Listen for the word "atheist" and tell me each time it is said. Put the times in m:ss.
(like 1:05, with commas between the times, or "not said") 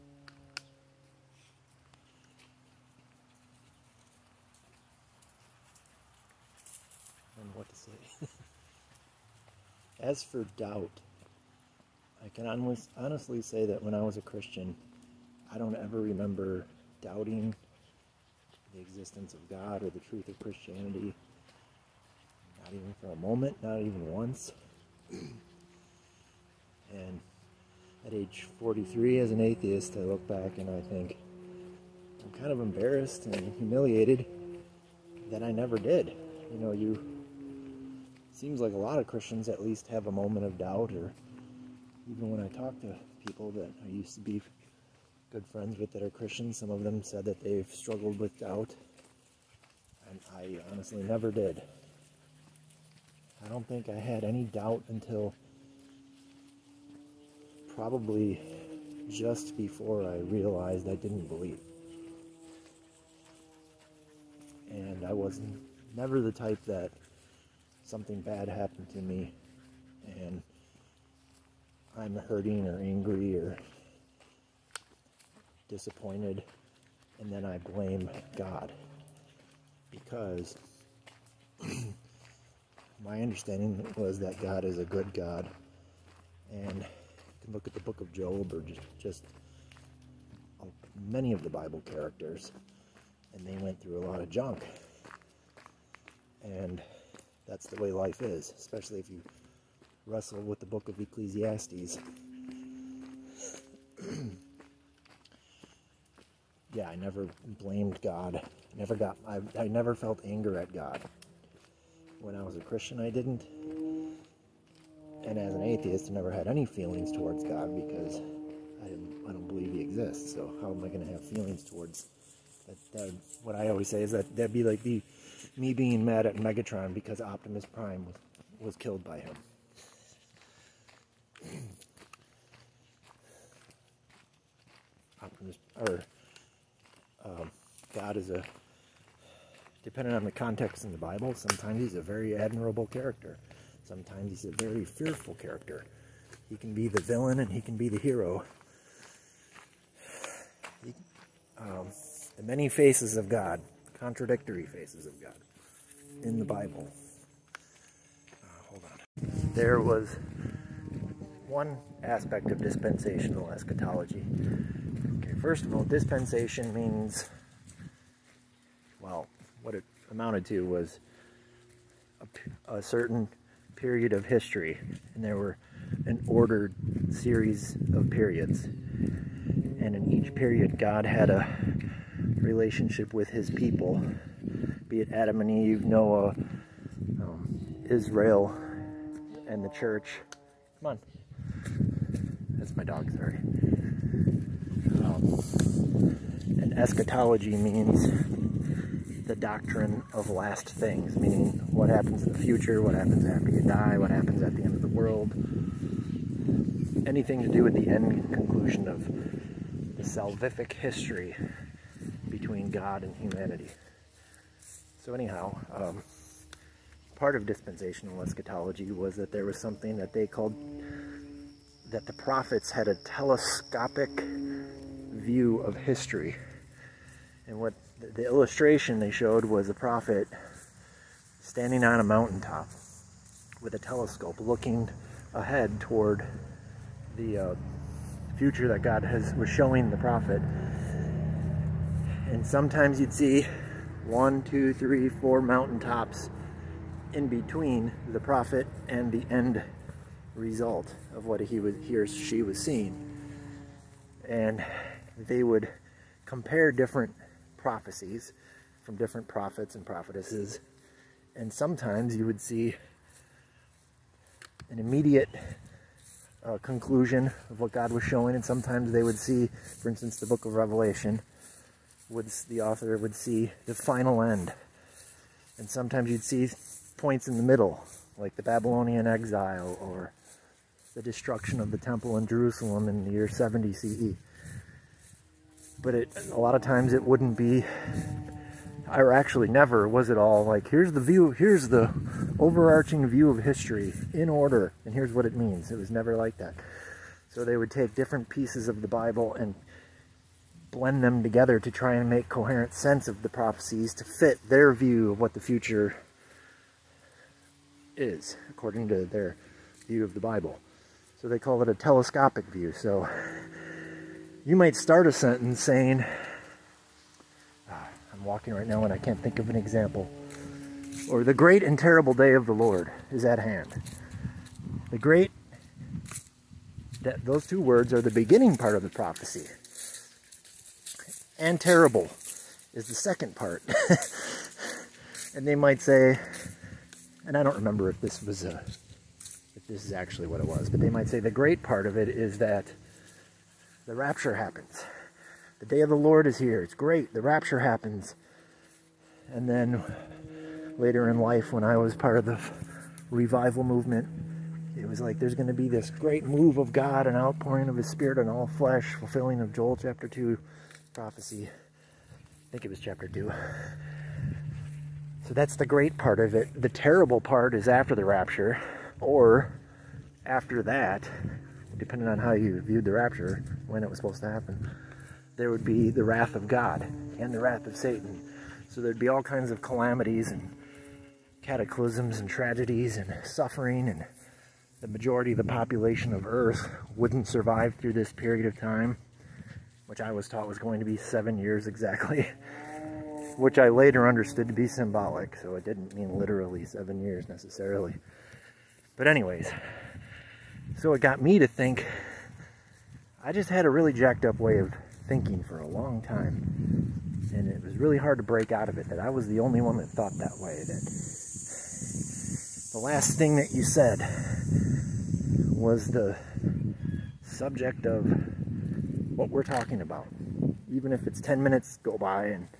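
0:29, 1:55.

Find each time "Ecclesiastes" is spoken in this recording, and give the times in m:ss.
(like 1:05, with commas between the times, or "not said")
1:40.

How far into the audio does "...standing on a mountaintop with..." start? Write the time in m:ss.
3:51.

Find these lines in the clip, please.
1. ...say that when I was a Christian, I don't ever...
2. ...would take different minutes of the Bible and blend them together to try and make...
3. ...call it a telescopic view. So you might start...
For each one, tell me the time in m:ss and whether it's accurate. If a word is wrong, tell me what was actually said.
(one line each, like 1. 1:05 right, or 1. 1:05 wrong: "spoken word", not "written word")
1. 0:13 right
2. 4:57 wrong: "pieces", not "minutes"
3. 5:11 right.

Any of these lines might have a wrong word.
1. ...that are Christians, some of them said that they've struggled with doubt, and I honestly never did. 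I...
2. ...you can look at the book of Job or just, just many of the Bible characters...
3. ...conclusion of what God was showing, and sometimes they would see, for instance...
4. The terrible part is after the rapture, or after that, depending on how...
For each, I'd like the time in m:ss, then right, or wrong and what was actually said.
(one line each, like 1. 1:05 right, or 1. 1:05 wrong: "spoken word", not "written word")
1. 0:45 right
2. 1:26 right
3. 4:26 right
4. 6:06 right.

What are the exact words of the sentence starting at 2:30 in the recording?
He, um, the many faces of God contradictory faces of God in the Bible.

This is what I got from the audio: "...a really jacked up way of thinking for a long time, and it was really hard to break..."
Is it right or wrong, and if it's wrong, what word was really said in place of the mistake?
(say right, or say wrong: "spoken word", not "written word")
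right.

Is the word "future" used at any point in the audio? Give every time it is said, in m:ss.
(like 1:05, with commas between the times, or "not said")
3:22, 3:58, 5:05.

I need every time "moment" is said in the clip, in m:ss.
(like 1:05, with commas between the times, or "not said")
0:23, 0:40.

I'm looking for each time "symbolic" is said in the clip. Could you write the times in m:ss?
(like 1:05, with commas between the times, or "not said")
6:34.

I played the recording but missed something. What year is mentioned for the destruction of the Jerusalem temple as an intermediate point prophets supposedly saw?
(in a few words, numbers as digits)
70 CE.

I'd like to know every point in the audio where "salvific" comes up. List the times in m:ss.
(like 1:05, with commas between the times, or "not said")
3:30.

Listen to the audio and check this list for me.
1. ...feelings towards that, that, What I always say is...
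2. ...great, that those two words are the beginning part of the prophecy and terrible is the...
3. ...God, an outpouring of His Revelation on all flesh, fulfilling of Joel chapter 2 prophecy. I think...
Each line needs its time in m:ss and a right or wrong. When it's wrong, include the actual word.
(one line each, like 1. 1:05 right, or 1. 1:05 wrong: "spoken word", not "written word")
1. 2:01 right
2. 5:24 right
3. 5:56 wrong: "Spirit", not "Revelation".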